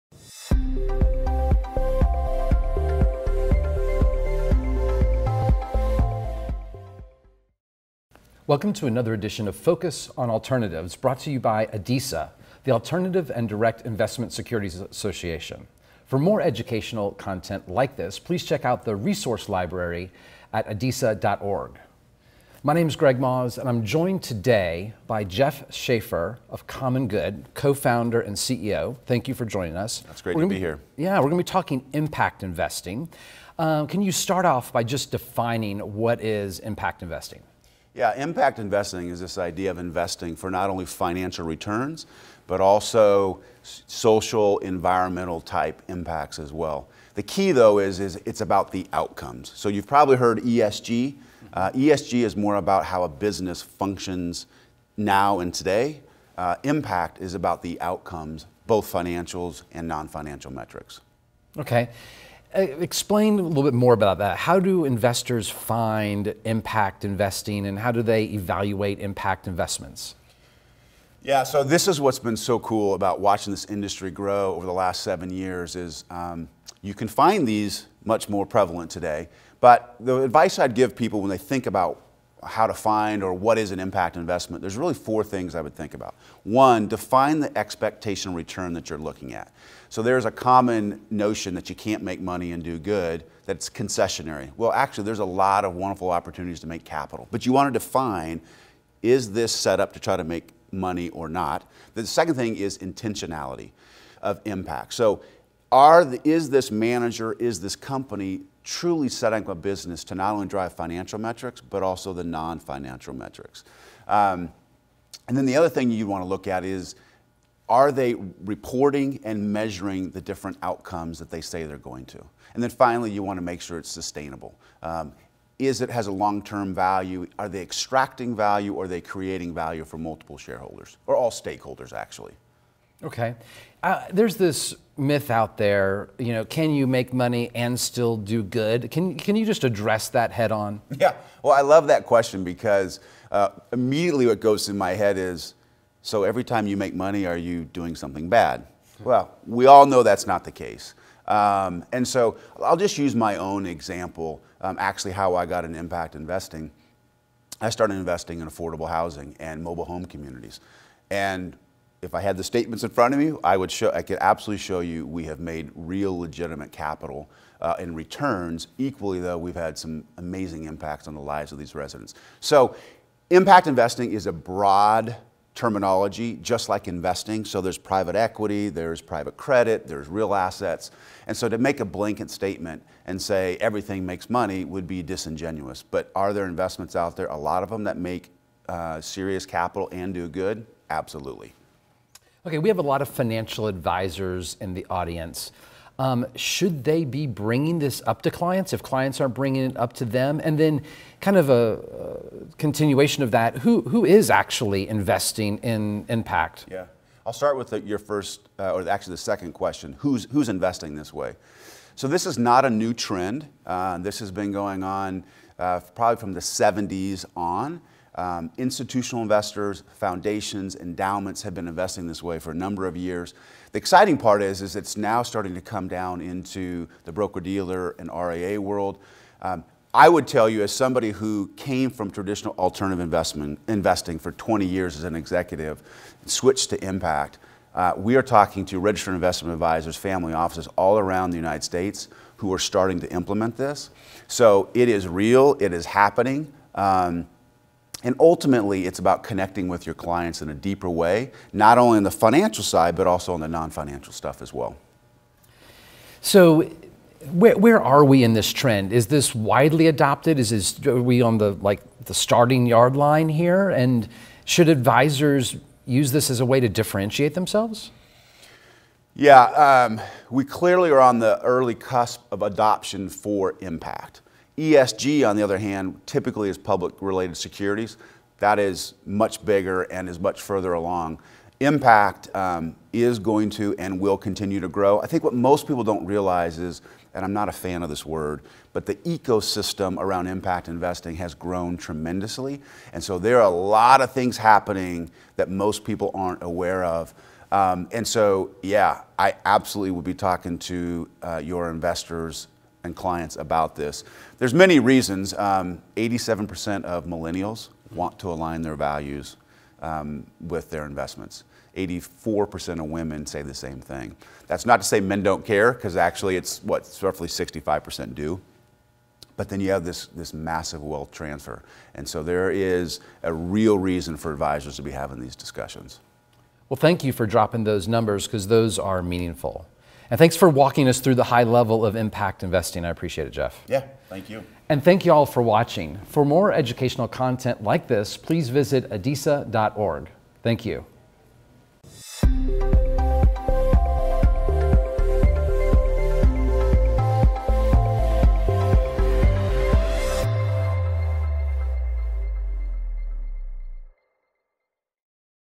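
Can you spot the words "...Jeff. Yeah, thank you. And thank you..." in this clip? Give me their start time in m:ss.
5:33.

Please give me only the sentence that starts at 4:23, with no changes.
And should advisors use this as a way to differentiate themselves?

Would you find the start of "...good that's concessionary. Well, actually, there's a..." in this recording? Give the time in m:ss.
1:32.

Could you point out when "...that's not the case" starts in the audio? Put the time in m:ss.
2:30.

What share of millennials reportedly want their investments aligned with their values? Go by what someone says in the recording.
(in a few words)
87%.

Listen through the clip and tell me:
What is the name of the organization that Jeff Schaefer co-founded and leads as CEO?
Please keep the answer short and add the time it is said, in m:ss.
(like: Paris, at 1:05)
Uncommon Good, at 0:26.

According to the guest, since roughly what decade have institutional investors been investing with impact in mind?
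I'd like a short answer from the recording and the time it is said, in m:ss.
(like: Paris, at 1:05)
the 70s, at 3:36.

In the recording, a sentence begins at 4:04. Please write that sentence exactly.
So it is real, it is happening.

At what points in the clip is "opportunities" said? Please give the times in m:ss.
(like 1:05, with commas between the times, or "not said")
1:36.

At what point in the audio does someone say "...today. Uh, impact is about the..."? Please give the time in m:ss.
0:55.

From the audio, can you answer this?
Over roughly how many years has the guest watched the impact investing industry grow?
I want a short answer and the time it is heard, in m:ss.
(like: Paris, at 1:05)
7, at 1:15.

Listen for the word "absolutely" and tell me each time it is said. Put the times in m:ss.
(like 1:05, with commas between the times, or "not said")
2:44, 3:10, 4:59.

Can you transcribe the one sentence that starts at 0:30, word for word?
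That's great we're to be, be here.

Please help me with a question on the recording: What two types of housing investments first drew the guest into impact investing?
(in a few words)
affordable housing and mobile home communities.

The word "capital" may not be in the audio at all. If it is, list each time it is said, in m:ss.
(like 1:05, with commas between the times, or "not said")
1:36, 2:46, 3:09.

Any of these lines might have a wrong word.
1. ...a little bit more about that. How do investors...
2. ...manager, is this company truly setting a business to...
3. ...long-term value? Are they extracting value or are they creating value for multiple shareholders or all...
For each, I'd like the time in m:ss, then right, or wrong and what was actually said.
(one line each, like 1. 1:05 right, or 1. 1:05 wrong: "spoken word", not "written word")
1. 1:03 right
2. 1:46 right
3. 2:06 right.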